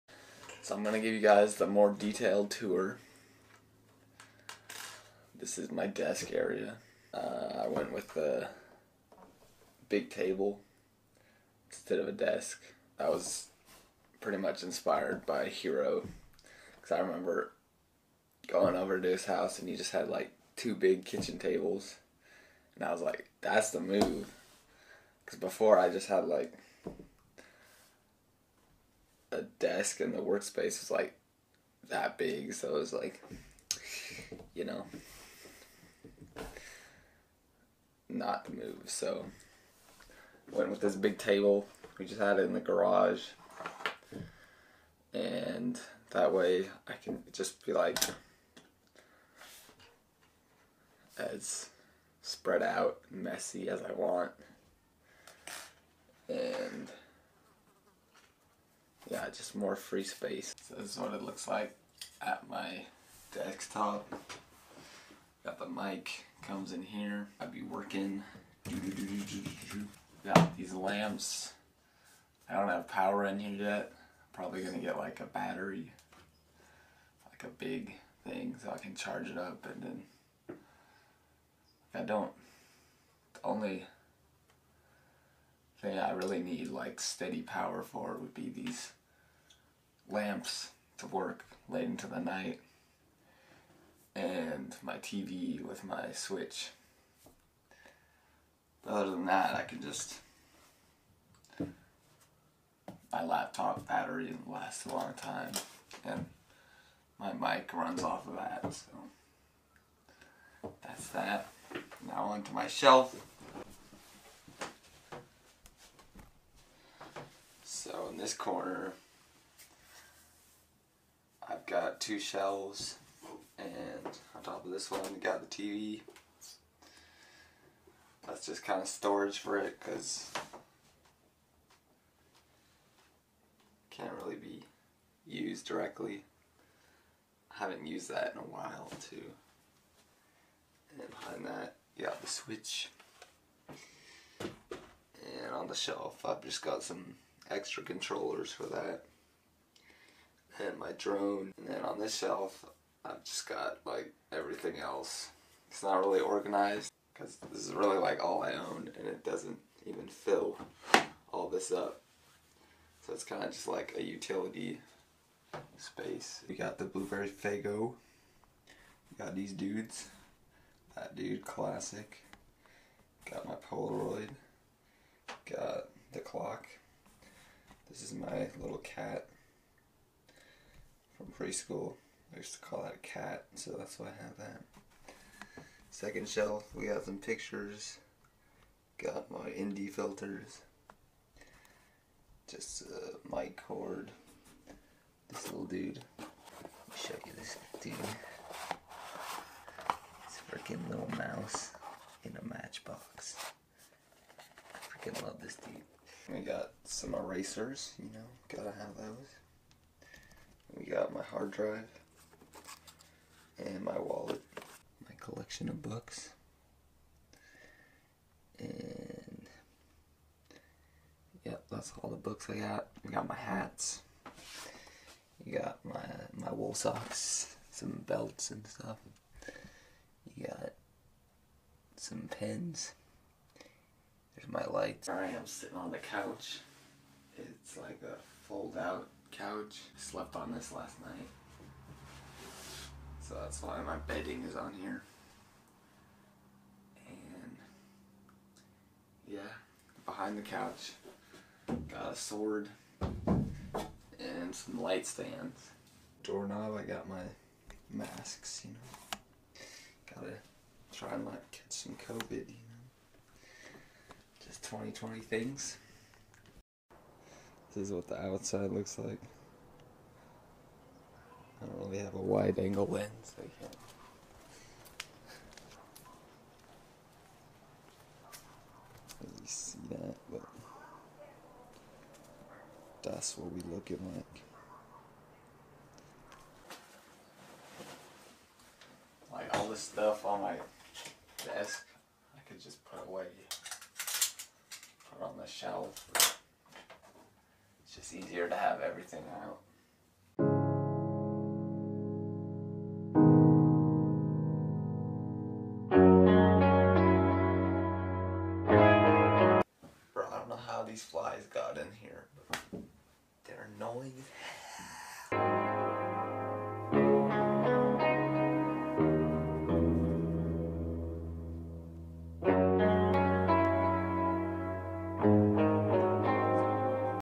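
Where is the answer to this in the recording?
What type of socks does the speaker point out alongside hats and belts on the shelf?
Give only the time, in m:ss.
3:46.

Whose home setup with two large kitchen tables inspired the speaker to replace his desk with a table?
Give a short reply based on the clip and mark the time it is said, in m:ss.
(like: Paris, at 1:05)
Hero, at 0:15.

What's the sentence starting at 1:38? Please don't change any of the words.
But other than that, I can just.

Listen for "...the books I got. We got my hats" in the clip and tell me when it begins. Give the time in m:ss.
3:42.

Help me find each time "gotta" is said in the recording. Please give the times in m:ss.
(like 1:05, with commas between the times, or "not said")
3:28, 4:20.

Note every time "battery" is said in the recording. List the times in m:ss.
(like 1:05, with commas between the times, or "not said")
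1:15, 1:43.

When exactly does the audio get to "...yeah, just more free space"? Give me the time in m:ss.
0:59.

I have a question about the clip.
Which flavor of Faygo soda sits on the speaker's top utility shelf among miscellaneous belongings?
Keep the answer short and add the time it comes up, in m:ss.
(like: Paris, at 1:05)
Blueberry, at 2:46.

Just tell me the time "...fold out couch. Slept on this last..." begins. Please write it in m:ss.
3:58.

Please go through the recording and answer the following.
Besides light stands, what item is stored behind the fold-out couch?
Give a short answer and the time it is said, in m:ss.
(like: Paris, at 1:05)
A sword, at 4:12.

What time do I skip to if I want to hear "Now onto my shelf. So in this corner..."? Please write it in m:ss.
1:52.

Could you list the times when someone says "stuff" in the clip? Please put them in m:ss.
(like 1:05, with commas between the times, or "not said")
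3:48, 4:49.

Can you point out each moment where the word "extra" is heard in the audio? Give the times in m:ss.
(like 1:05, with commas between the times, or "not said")
2:27.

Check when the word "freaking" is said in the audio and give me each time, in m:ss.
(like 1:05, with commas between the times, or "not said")
3:20, 3:24.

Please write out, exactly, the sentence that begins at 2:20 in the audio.
And behind that, you got the switch.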